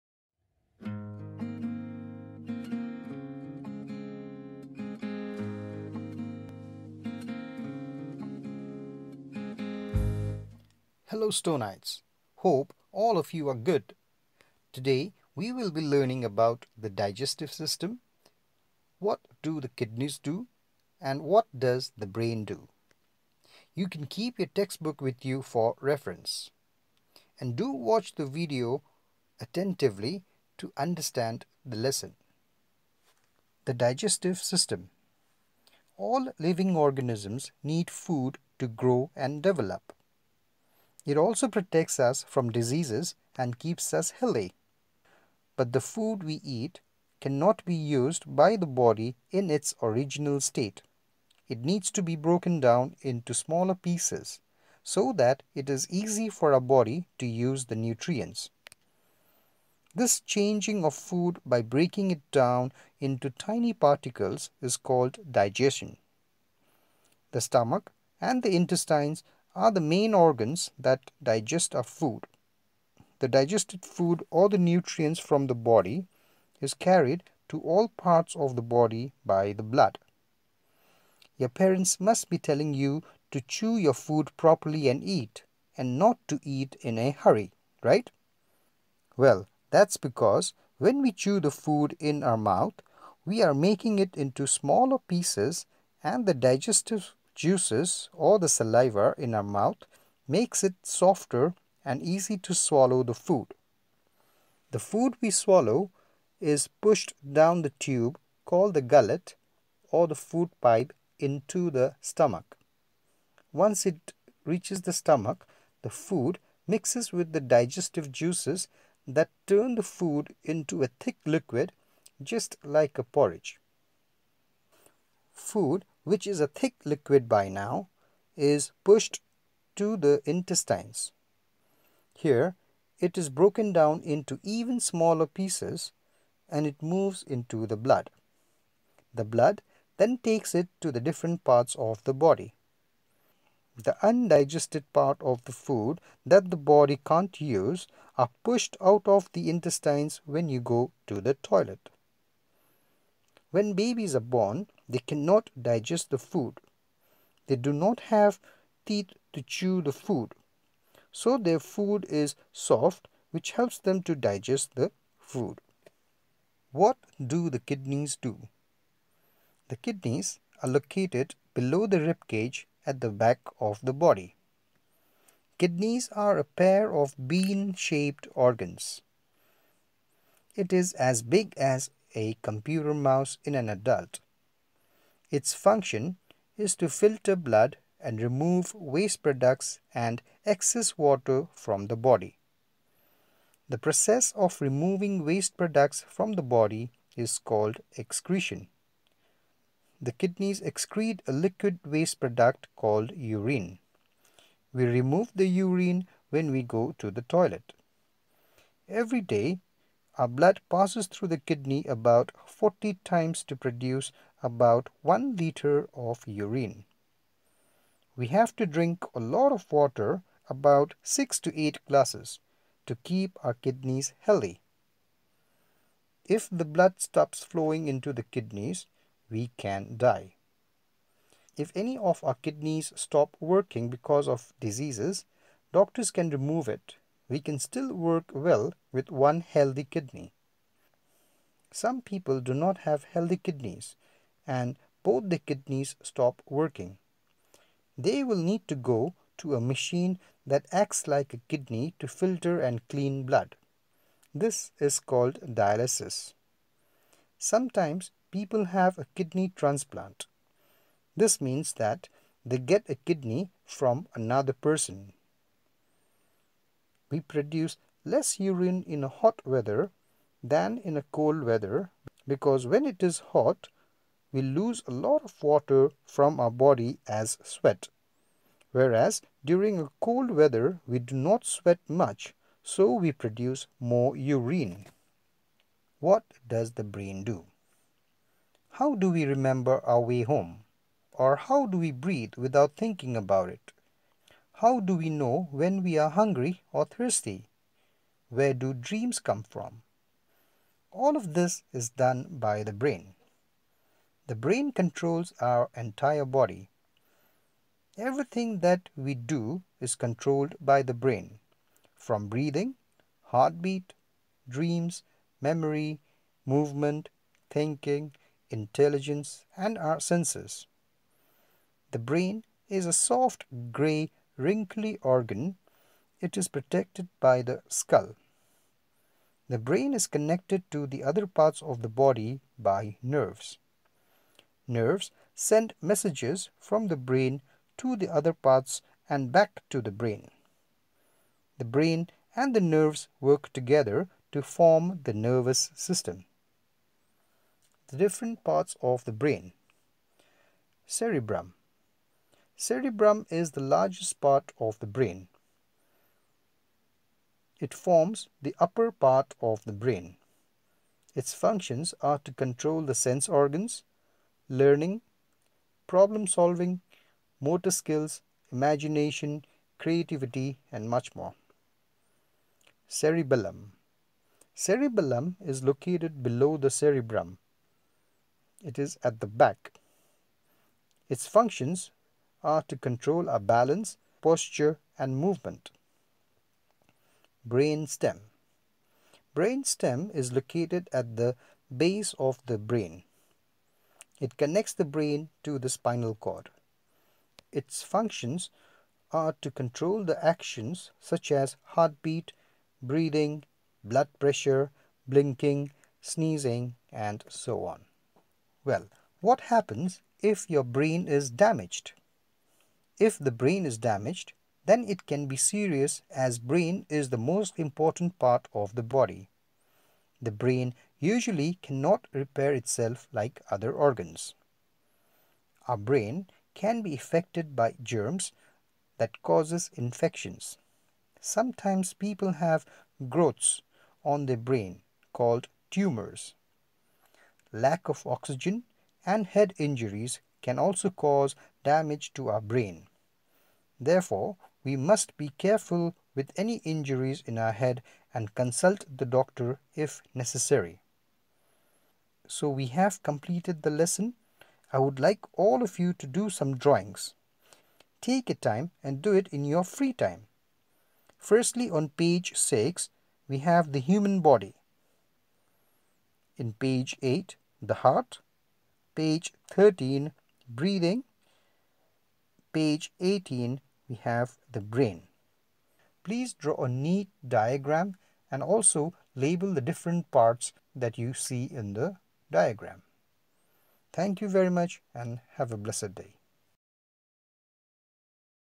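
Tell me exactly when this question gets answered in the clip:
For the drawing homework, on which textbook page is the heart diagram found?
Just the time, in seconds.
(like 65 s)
466 s.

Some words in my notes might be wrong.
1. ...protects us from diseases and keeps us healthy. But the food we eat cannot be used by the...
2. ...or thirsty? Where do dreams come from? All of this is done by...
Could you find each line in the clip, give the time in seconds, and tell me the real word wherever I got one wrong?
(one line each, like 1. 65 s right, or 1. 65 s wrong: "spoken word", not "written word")
1. 41 s right
2. 296 s right.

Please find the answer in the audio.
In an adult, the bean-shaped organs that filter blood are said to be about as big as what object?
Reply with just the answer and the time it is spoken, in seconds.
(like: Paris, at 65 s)
a computer mouse, at 182 s.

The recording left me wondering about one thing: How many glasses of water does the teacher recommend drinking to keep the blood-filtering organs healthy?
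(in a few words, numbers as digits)
6 to 8.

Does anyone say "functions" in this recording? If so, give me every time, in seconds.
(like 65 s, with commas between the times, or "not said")
185 s, 361 s, 381 s, 397 s.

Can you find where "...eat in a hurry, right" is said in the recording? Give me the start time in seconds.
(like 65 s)
86 s.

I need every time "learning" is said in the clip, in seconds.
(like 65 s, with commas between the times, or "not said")
15 s, 364 s.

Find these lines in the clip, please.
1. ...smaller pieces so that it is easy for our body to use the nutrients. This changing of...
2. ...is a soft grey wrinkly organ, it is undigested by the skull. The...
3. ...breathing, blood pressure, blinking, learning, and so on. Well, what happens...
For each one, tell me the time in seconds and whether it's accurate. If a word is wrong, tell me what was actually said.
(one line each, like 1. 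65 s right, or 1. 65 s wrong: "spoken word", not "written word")
1. 53 s right
2. 322 s wrong: "protected", not "undigested"
3. 402 s wrong: "sneezing", not "learning".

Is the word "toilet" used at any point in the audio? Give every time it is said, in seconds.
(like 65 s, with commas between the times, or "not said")
151 s, 207 s.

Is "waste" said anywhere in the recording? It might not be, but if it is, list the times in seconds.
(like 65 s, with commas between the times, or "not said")
188 s, 195 s, 201 s.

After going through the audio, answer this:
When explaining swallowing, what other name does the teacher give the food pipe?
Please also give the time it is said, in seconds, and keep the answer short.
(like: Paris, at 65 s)
gullet, at 108 s.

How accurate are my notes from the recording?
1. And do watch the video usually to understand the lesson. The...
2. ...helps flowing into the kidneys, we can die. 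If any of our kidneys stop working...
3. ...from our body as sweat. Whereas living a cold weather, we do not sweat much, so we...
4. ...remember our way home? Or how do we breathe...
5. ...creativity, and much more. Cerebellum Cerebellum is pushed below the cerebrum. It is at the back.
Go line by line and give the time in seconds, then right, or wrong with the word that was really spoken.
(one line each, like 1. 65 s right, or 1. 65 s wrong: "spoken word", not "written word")
1. 27 s wrong: "attentively", not "usually"
2. 226 s wrong: "stops", not "helps"
3. 276 s wrong: "during", not "living"
4. 289 s right
5. 369 s wrong: "located", not "pushed".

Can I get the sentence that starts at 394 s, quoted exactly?
It connects the brain to the spinal cord.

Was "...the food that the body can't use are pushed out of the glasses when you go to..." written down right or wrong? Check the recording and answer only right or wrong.
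wrong.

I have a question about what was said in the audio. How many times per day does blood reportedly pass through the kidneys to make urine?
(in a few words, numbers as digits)
40.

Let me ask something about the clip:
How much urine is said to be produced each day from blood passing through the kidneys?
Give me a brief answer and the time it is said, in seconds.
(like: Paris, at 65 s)
1 liter, at 215 s.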